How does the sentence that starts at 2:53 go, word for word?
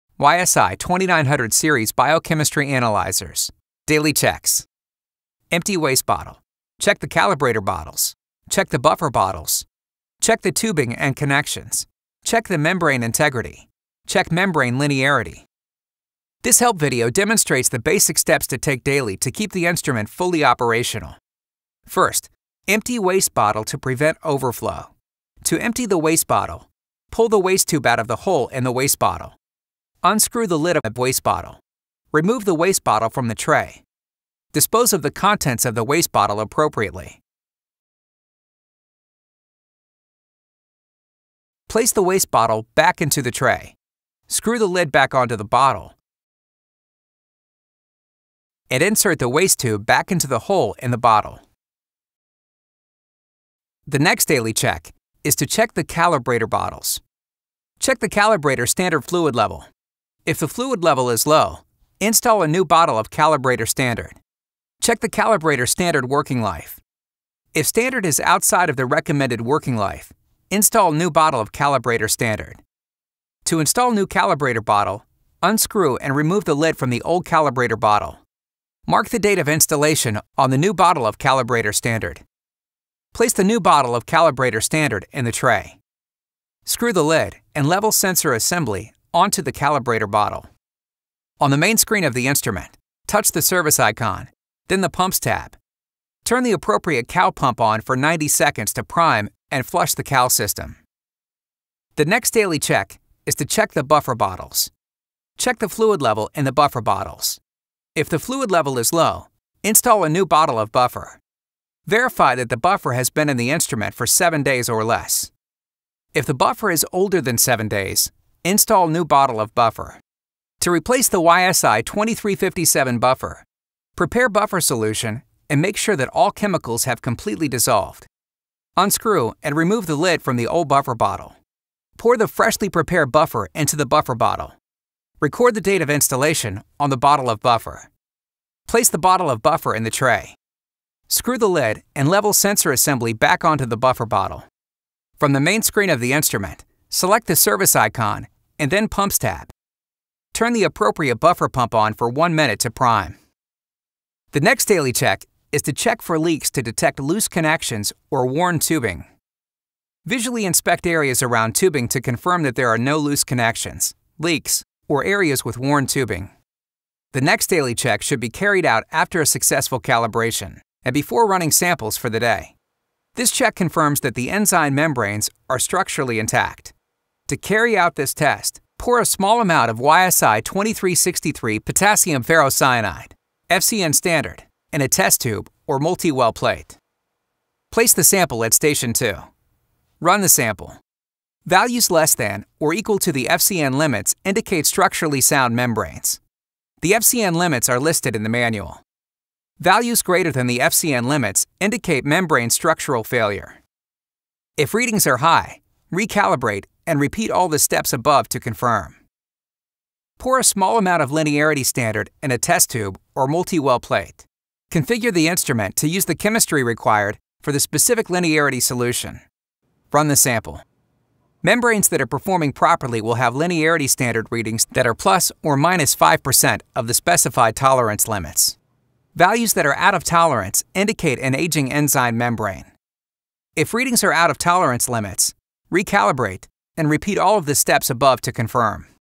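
This check confirms that the enzyme membranes are structurally intact.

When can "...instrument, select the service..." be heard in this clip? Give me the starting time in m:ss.
2:26.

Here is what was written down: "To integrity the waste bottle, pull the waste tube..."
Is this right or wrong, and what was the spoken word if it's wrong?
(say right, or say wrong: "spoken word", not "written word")
wrong: "empty", not "integrity".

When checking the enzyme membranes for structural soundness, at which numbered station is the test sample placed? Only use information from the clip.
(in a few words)
2.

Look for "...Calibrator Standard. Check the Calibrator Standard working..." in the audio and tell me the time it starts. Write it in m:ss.
1:03.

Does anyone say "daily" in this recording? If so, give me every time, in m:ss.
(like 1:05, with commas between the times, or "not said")
0:03, 0:18, 0:54, 1:42, 2:34, 2:47.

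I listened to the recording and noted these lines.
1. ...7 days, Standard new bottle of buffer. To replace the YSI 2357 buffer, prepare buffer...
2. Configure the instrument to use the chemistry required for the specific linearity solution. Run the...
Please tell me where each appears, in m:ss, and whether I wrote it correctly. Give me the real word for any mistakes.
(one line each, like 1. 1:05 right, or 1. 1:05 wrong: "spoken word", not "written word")
1. 1:57 wrong: "Install", not "Standard"
2. 3:34 right.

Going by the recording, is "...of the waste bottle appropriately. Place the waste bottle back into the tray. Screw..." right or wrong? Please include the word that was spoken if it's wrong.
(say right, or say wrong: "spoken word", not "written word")
right.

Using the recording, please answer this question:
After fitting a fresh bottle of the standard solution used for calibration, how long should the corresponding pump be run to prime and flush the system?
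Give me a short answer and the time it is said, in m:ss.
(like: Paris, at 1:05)
90 seconds, at 1:37.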